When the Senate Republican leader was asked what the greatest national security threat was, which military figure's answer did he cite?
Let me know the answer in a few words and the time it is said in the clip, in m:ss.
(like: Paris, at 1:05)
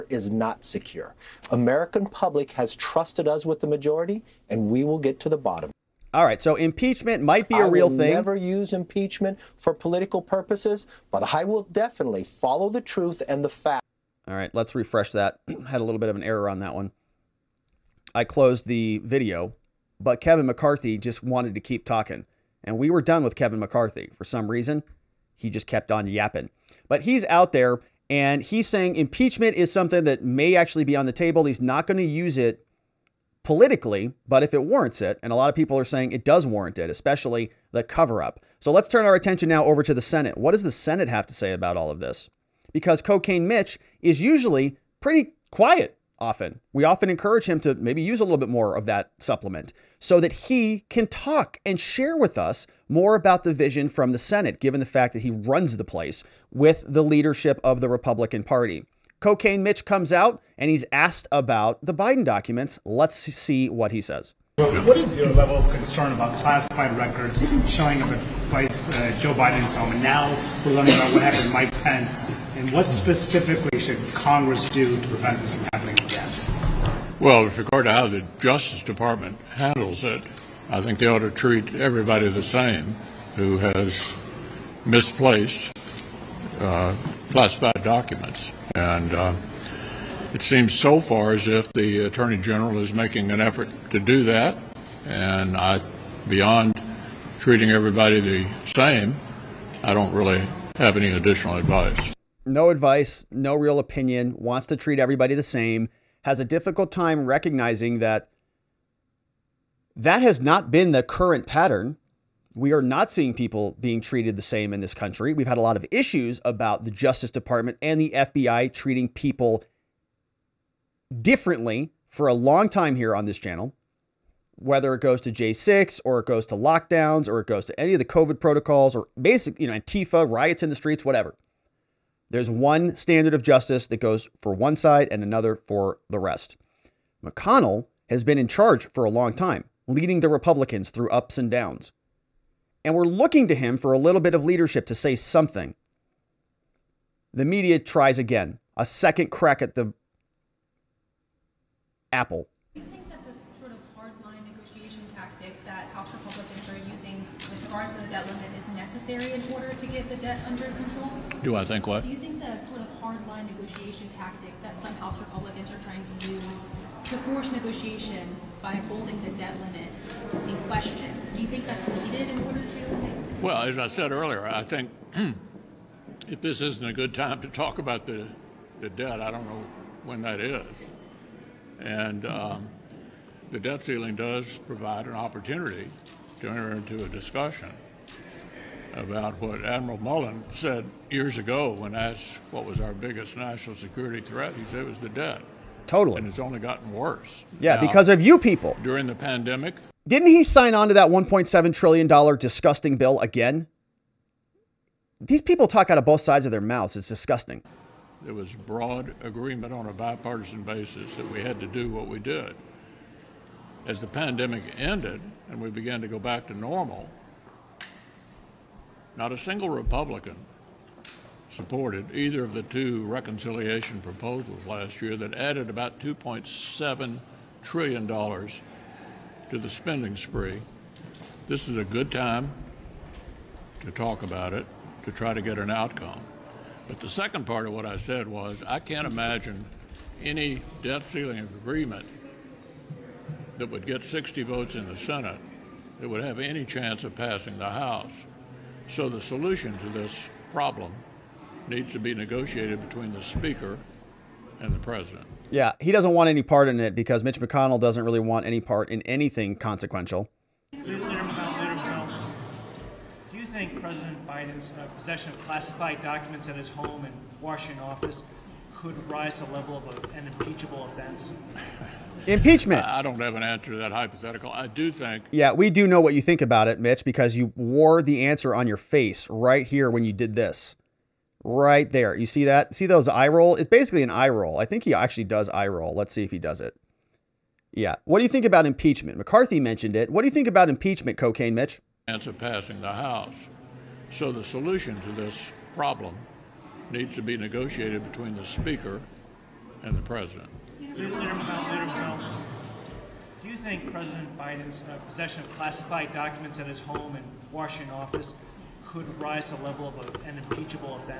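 Admiral Mullen, at 3:09.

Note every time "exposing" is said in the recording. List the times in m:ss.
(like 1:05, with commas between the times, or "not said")
not said.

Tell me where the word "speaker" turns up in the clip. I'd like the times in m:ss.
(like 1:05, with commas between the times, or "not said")
4:13, 4:58.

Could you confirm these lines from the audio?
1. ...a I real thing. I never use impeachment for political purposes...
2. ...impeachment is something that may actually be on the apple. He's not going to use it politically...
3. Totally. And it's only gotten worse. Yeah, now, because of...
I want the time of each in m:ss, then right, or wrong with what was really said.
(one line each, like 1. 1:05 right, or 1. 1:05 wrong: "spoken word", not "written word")
1. 0:07 right
2. 0:28 wrong: "table", not "apple"
3. 3:15 right.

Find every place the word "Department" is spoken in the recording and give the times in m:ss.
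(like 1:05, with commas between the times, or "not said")
1:18, 1:57.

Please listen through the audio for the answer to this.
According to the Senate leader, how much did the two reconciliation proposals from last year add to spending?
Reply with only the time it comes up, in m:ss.
3:45.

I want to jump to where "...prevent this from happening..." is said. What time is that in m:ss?
1:15.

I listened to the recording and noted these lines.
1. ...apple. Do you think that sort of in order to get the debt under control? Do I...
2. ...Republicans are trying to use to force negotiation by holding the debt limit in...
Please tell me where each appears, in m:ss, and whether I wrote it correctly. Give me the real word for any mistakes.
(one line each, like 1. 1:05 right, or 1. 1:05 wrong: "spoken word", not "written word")
1. 2:32 right
2. 2:45 right.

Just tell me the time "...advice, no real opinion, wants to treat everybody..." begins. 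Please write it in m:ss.
1:42.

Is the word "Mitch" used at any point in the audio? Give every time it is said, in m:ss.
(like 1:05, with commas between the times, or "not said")
0:43, 0:59, 4:17, 4:36, 4:51.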